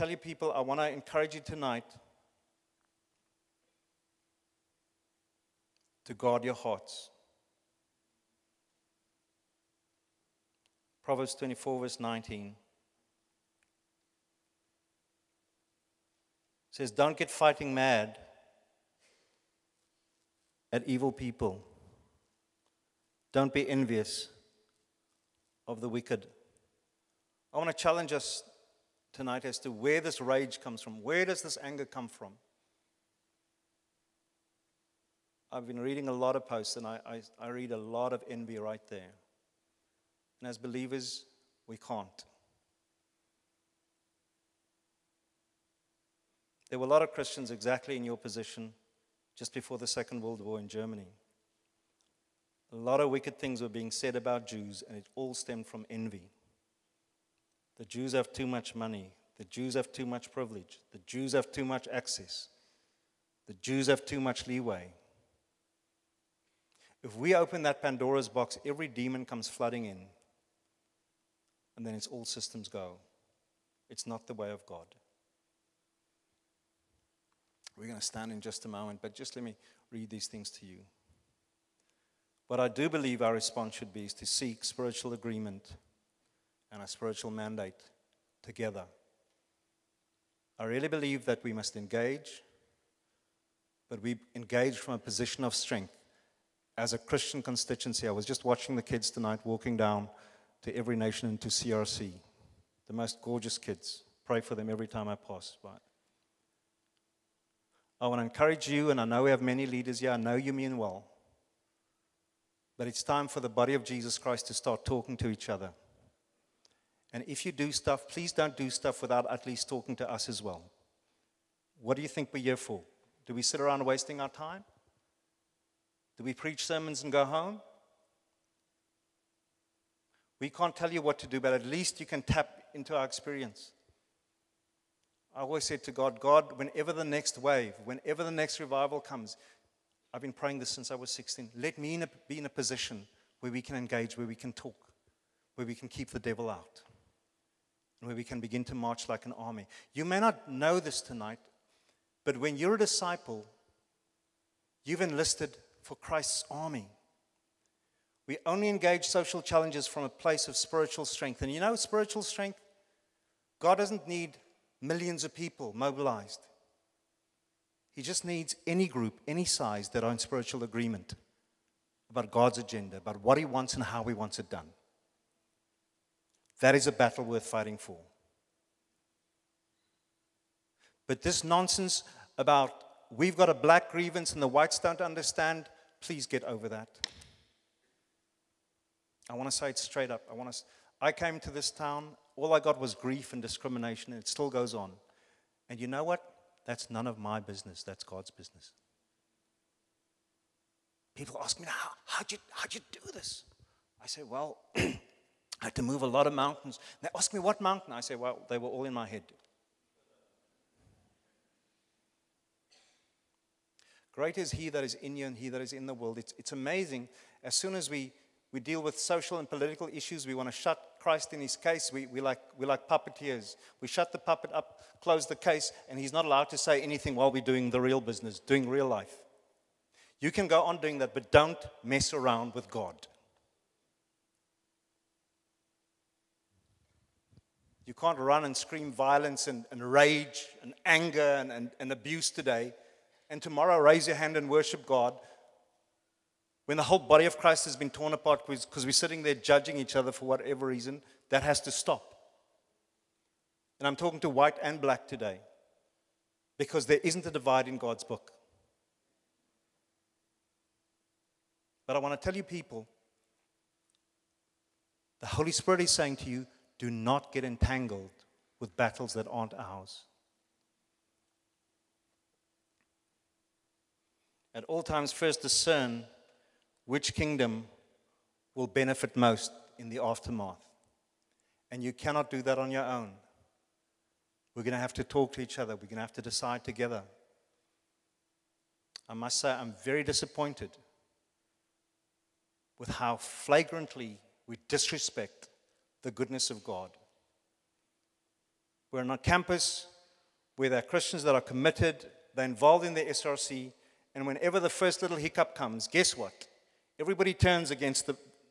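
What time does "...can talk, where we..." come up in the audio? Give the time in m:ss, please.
2:24.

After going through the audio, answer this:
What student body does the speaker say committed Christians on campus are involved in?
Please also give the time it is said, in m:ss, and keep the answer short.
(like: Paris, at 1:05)
SRC, at 5:03.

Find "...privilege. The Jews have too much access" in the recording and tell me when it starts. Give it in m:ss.
1:00.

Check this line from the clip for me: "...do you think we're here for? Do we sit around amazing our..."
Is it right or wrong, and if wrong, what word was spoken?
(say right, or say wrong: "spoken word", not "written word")
wrong: "wasting", not "amazing".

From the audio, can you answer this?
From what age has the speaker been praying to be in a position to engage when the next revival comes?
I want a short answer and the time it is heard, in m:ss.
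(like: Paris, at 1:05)
16, at 2:21.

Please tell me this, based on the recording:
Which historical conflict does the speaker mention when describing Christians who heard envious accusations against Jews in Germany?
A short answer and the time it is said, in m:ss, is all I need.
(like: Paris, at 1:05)
Second World War, at 0:49.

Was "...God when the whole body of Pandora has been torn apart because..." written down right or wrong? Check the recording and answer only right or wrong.
wrong.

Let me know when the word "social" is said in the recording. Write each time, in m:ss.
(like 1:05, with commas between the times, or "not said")
2:39, 3:38.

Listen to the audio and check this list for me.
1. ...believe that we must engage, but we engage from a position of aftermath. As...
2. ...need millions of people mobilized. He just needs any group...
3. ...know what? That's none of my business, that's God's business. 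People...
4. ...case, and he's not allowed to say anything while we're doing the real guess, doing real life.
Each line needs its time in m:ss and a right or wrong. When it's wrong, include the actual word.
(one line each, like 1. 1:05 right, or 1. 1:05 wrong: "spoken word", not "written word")
1. 1:30 wrong: "strength", not "aftermath"
2. 2:44 right
3. 3:15 right
4. 3:45 wrong: "business", not "guess".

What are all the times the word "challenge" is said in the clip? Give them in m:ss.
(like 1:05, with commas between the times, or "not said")
0:27, 2:39.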